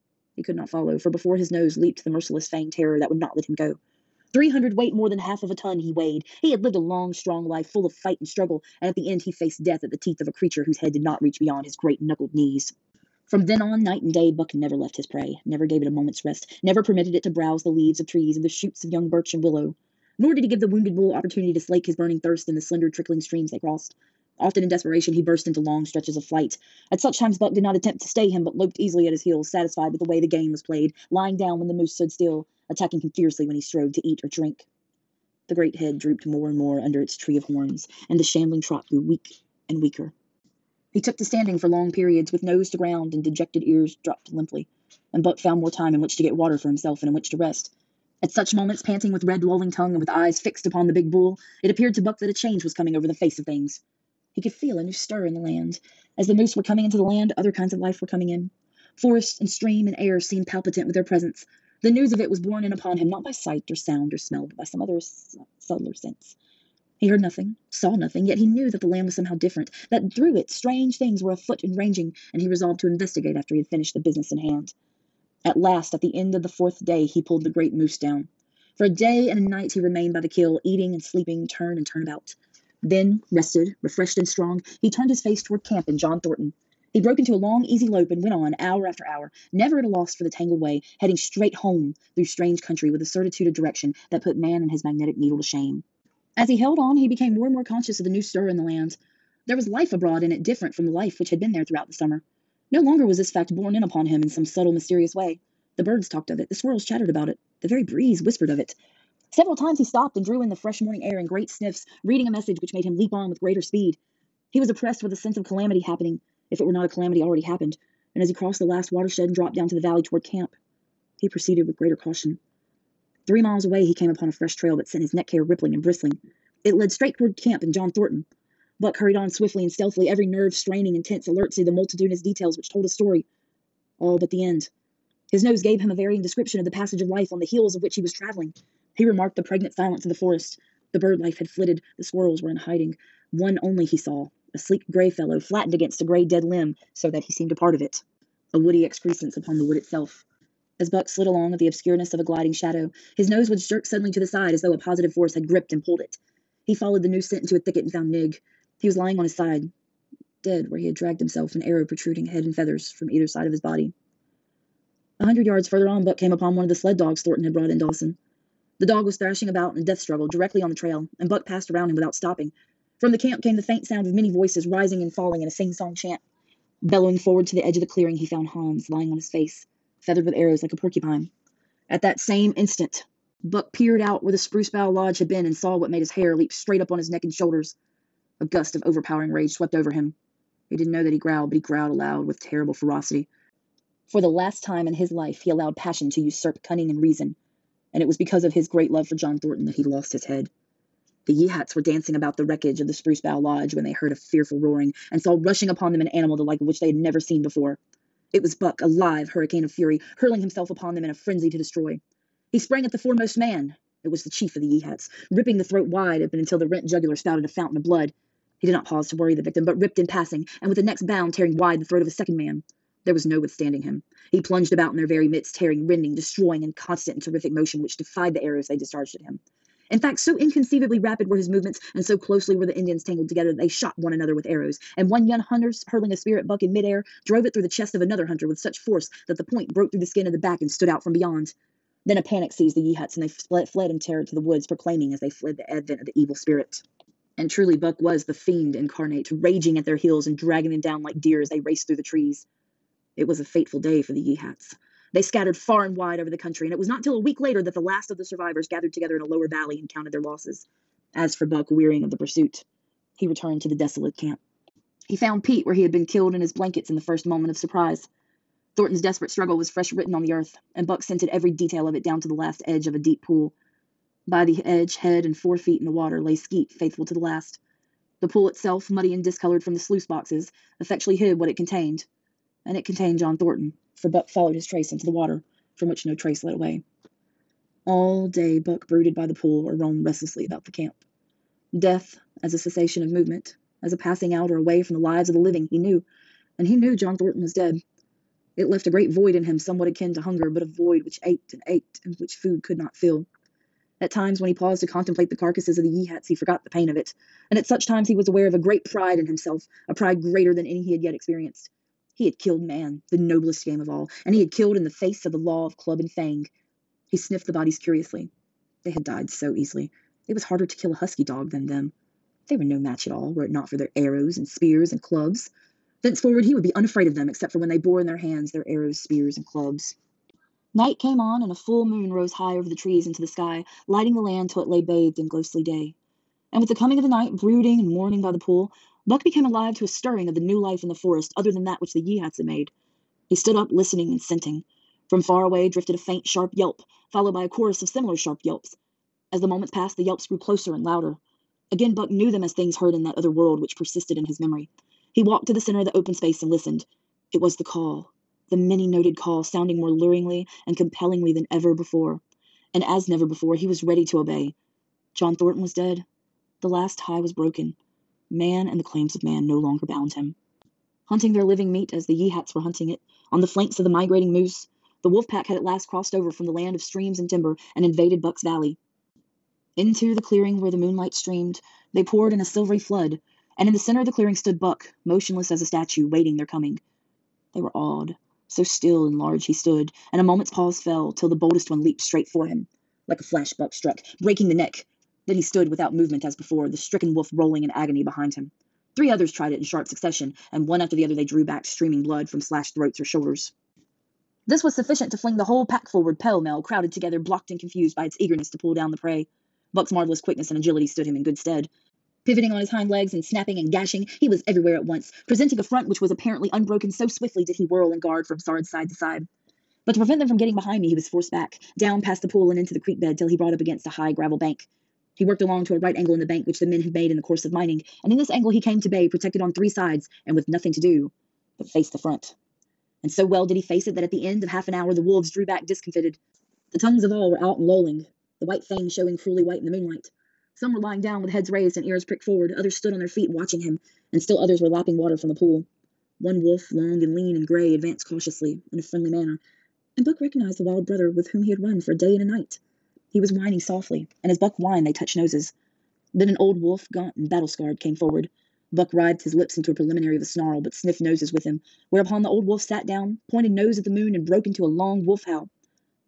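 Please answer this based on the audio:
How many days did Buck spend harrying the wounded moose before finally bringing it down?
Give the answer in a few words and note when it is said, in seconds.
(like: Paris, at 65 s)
4, at 76 s.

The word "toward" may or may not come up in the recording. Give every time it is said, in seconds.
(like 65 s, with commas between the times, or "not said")
85 s, 120 s, 127 s.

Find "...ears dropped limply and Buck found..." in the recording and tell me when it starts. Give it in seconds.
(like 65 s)
43 s.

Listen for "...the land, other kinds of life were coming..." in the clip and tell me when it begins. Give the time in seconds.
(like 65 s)
56 s.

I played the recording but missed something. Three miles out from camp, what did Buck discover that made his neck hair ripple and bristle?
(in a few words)
A fresh trail.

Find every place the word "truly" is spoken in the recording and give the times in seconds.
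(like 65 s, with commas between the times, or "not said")
247 s.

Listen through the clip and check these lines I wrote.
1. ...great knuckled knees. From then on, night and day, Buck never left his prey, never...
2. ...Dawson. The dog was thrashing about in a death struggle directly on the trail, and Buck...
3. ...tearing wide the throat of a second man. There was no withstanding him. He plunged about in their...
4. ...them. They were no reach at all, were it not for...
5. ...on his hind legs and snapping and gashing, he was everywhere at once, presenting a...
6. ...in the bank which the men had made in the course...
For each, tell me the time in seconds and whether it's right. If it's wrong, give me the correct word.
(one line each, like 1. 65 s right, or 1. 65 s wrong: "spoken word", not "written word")
1. 11 s right
2. 167 s right
3. 221 s right
4. 321 s wrong: "match", not "reach"
5. 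412 s right
6. 426 s right.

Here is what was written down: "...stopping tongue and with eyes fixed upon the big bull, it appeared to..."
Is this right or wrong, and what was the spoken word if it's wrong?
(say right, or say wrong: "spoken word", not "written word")
wrong: "lolling", not "stopping".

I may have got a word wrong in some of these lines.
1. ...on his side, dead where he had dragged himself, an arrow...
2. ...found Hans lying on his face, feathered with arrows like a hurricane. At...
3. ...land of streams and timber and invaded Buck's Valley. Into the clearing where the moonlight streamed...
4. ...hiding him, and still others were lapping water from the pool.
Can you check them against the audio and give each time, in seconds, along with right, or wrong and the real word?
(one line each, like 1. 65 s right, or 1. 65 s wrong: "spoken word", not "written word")
1. 159 s right
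2. 178 s wrong: "porcupine", not "hurricane"
3. 376 s right
4. 443 s wrong: "watching", not "hiding".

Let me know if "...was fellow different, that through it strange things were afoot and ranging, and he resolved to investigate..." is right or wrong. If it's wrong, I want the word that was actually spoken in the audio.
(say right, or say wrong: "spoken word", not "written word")
wrong: "somehow", not "fellow".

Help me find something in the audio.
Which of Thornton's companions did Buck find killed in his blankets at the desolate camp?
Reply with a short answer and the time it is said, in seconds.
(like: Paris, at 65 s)
Pete, at 265 s.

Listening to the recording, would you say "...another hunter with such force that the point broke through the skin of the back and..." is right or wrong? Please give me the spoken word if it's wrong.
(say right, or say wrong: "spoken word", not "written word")
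right.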